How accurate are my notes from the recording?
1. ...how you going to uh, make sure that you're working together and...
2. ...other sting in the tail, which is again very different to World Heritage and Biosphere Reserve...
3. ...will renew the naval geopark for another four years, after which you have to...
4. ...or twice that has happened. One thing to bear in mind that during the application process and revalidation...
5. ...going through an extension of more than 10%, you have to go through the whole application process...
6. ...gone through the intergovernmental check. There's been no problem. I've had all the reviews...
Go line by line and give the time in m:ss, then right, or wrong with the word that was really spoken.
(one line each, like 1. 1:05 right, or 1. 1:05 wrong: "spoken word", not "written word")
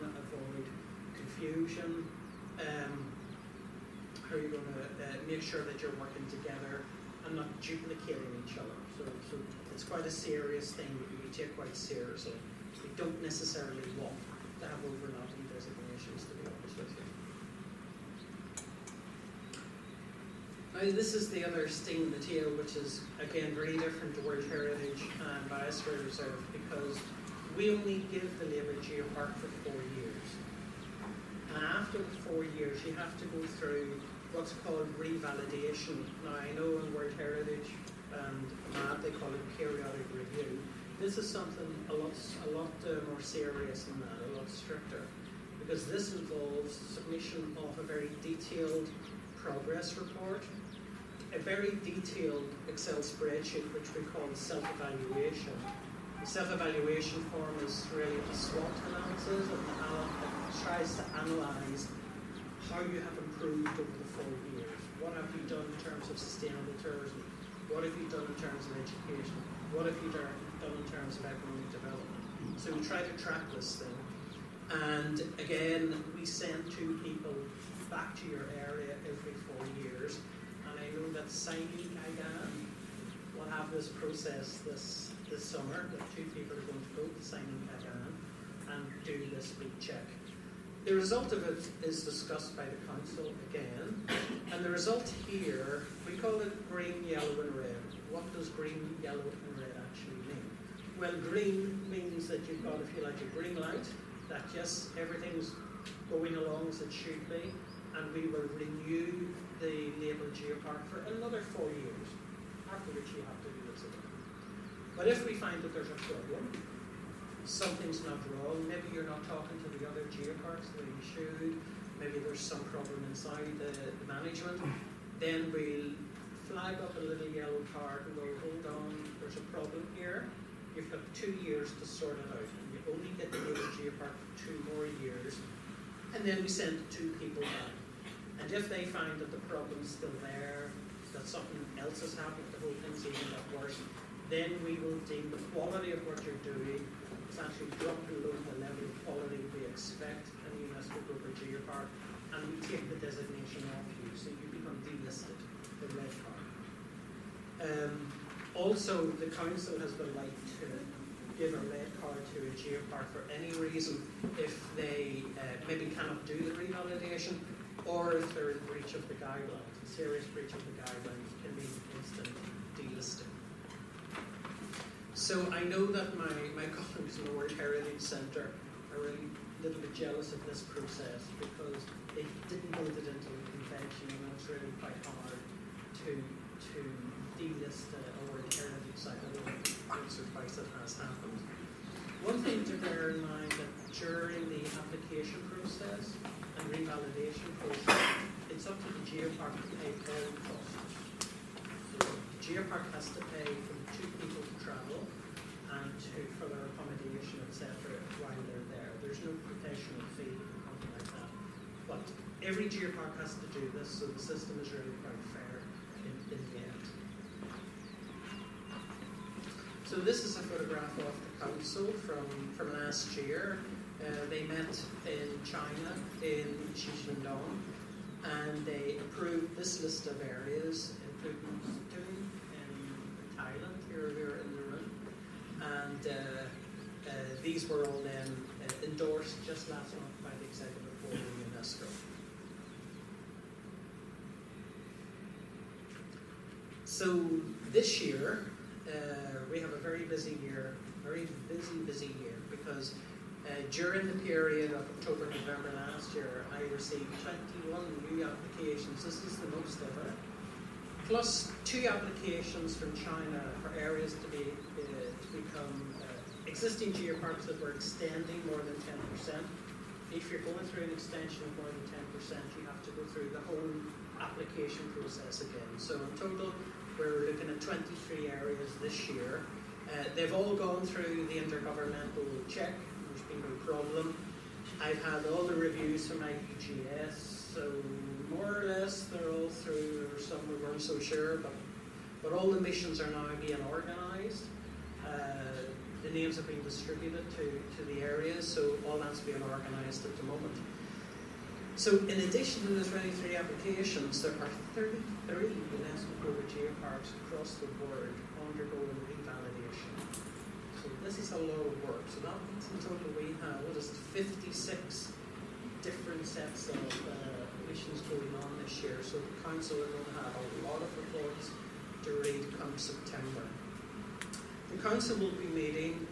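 1. 0:04 right
2. 0:21 right
3. 1:48 right
4. 3:10 right
5. 4:30 right
6. 4:40 right.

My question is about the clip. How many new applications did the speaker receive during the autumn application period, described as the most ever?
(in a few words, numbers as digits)
21.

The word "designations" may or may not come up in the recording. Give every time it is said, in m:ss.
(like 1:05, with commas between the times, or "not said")
0:15, 2:32.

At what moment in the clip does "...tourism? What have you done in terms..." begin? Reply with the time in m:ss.
1:06.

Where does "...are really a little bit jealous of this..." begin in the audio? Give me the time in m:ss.
2:58.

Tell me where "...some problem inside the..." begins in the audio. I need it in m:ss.
2:02.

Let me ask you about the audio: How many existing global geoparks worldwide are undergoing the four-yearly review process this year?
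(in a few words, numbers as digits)
33.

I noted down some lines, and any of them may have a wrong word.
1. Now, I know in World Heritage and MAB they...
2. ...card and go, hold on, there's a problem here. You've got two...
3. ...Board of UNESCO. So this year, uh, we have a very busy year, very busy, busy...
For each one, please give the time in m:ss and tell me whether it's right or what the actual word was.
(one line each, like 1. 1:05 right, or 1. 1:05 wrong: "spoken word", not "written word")
1. 0:36 right
2. 2:07 right
3. 4:01 right.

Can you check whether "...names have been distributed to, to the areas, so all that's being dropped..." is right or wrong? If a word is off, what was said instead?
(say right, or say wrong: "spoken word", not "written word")
wrong: "organised", not "dropped".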